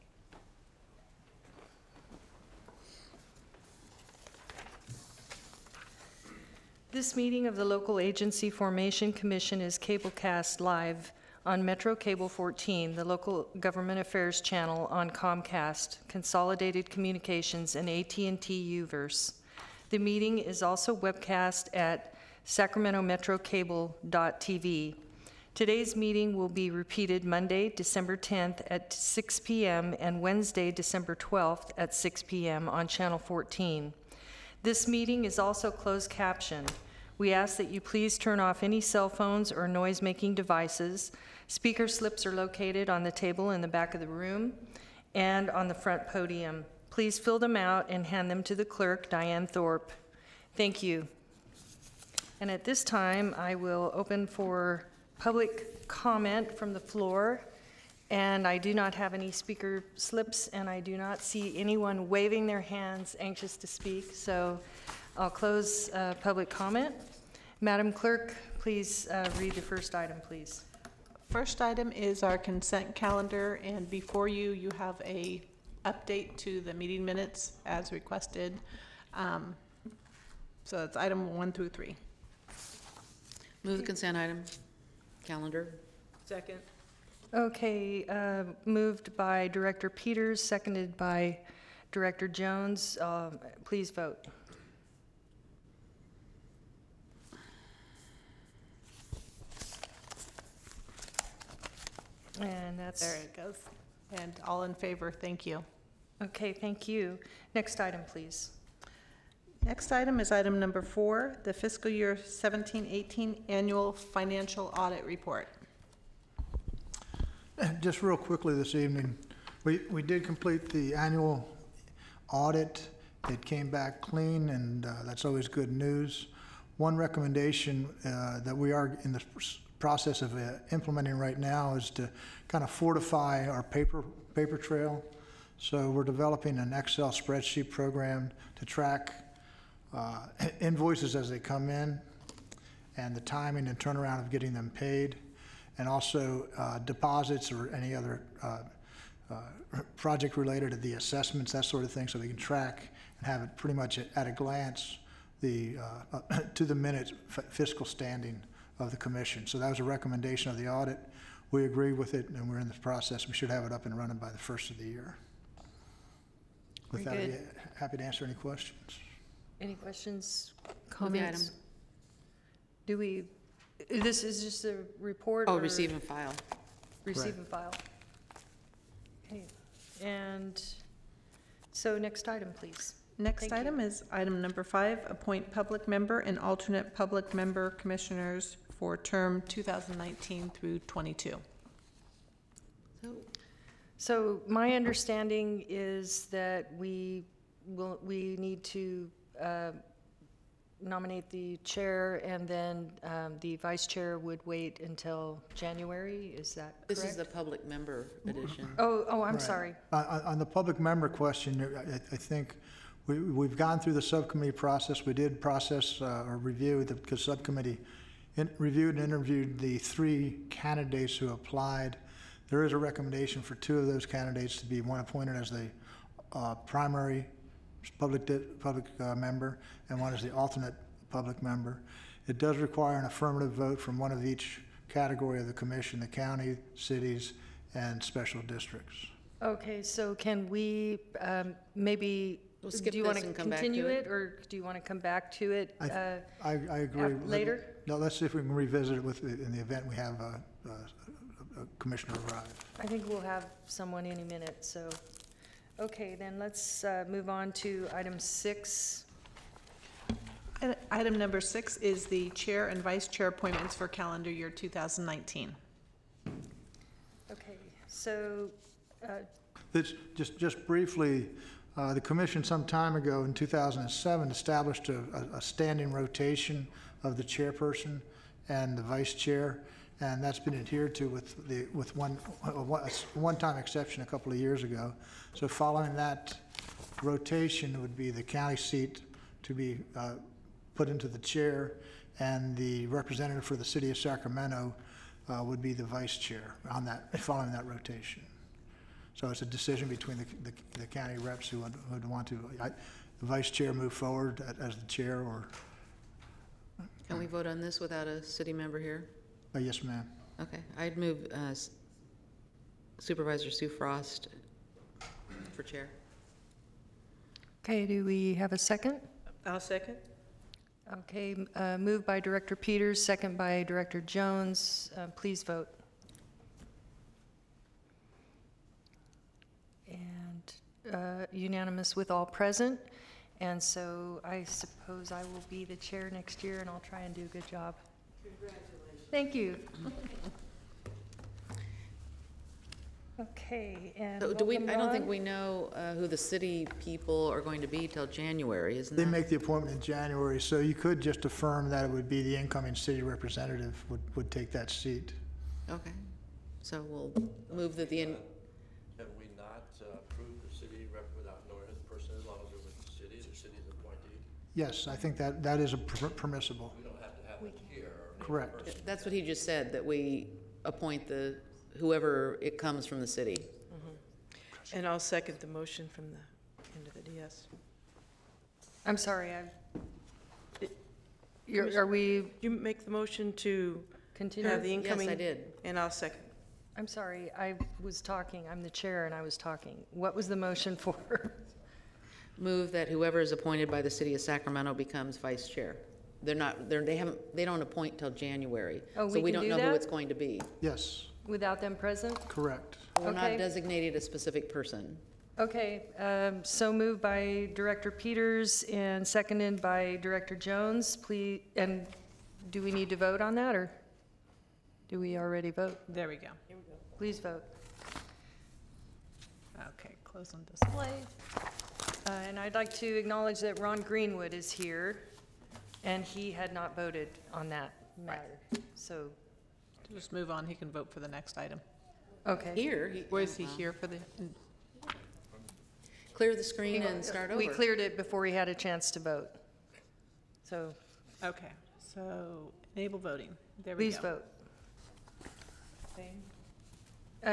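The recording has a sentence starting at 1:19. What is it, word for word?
Um, So it's item one through three.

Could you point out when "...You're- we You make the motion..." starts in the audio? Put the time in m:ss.
6:21.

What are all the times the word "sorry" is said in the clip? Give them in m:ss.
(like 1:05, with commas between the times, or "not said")
3:29, 6:18, 6:26.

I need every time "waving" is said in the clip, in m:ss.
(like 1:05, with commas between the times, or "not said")
1:02.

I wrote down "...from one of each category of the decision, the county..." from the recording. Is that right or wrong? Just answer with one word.
wrong.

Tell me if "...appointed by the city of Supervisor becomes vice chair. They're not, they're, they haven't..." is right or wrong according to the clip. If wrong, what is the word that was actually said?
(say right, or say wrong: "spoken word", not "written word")
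wrong: "Sacramento", not "Supervisor".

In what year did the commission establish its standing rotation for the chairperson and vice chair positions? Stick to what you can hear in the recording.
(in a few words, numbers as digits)
2007.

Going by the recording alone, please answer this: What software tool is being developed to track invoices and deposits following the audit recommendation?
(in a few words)
Excel spreadsheet.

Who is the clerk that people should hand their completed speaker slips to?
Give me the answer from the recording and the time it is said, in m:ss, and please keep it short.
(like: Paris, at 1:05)
Diane Thorpe, at 0:49.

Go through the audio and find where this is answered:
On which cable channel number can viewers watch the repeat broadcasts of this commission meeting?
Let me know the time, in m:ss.
0:32.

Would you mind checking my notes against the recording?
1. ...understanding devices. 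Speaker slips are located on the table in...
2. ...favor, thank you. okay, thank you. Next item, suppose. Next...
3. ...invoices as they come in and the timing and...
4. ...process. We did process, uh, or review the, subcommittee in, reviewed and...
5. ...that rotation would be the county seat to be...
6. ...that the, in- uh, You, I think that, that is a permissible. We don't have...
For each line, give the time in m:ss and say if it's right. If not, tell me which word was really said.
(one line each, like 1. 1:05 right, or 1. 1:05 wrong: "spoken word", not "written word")
1. 0:40 wrong: "making", not "understanding"
2. 1:44 wrong: "please", not "suppose"
3. 2:20 right
4. 3:34 right
5. 4:45 right
6. 5:57 wrong: "Yes", not "You".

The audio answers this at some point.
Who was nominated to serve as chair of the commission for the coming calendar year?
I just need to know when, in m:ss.
5:13.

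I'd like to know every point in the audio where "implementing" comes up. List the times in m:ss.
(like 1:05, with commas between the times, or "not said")
2:10.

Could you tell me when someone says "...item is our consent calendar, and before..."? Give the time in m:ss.
1:11.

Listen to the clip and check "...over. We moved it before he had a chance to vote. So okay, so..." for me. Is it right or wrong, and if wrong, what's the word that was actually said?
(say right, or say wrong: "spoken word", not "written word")
wrong: "cleared", not "moved".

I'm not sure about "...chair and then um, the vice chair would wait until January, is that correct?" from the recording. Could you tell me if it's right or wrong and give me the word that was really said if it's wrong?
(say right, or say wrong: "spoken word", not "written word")
right.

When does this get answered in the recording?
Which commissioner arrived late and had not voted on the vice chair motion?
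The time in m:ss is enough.
7:03.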